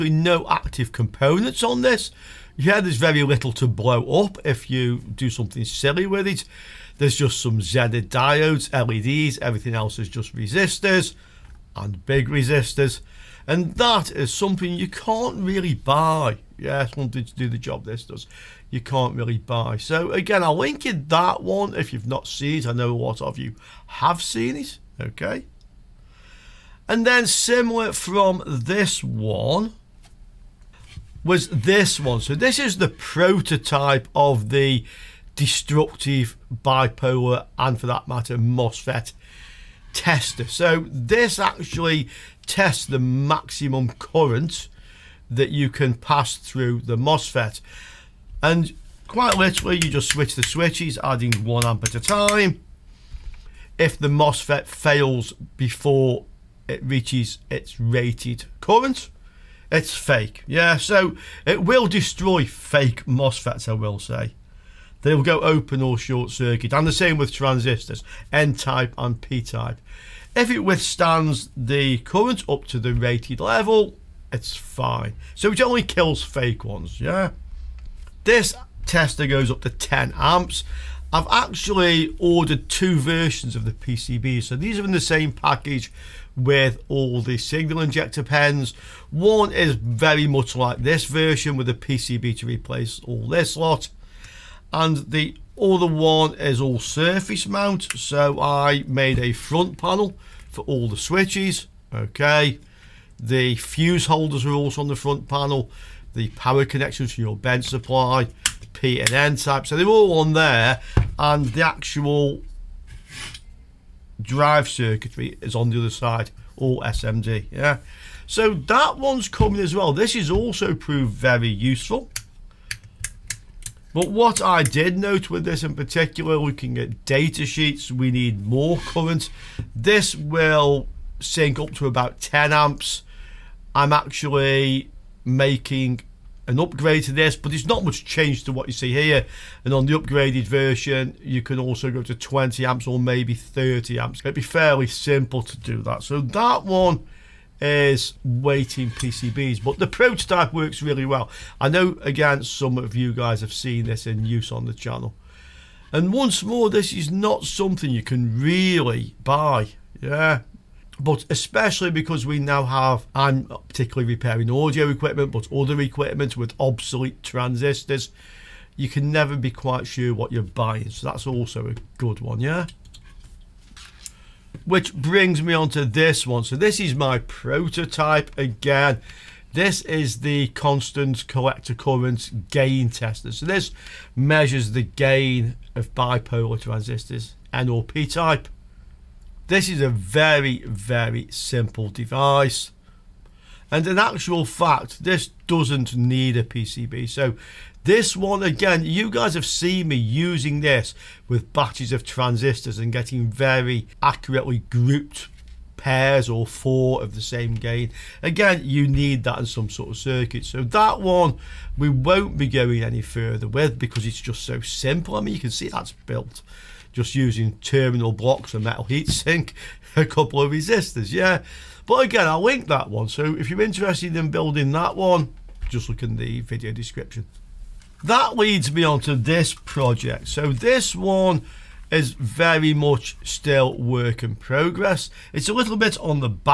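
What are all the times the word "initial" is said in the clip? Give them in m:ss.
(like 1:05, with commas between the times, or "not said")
not said.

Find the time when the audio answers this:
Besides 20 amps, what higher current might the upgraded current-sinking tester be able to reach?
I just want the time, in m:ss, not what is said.
2:23.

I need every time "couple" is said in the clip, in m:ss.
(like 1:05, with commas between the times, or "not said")
3:40.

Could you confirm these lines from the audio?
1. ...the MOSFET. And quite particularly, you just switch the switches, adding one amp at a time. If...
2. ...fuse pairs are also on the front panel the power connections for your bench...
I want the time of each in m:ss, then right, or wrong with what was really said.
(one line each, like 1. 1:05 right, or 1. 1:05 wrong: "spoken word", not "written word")
1. 0:46 wrong: "literally", not "particularly"
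2. 1:43 wrong: "holders", not "pairs".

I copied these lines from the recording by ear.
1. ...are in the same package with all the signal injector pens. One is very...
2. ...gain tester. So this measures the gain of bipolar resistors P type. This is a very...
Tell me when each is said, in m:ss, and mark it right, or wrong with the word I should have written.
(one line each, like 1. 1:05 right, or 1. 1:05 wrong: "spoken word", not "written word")
1. 1:24 right
2. 3:02 wrong: "transistors", not "resistors".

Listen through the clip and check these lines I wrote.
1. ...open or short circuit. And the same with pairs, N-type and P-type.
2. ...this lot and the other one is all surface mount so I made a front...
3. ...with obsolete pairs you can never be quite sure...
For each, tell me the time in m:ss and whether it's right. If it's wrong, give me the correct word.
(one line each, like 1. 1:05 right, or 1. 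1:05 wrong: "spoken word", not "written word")
1. 1:05 wrong: "transistors", not "pairs"
2. 1:33 right
3. 2:46 wrong: "transistors", not "pairs".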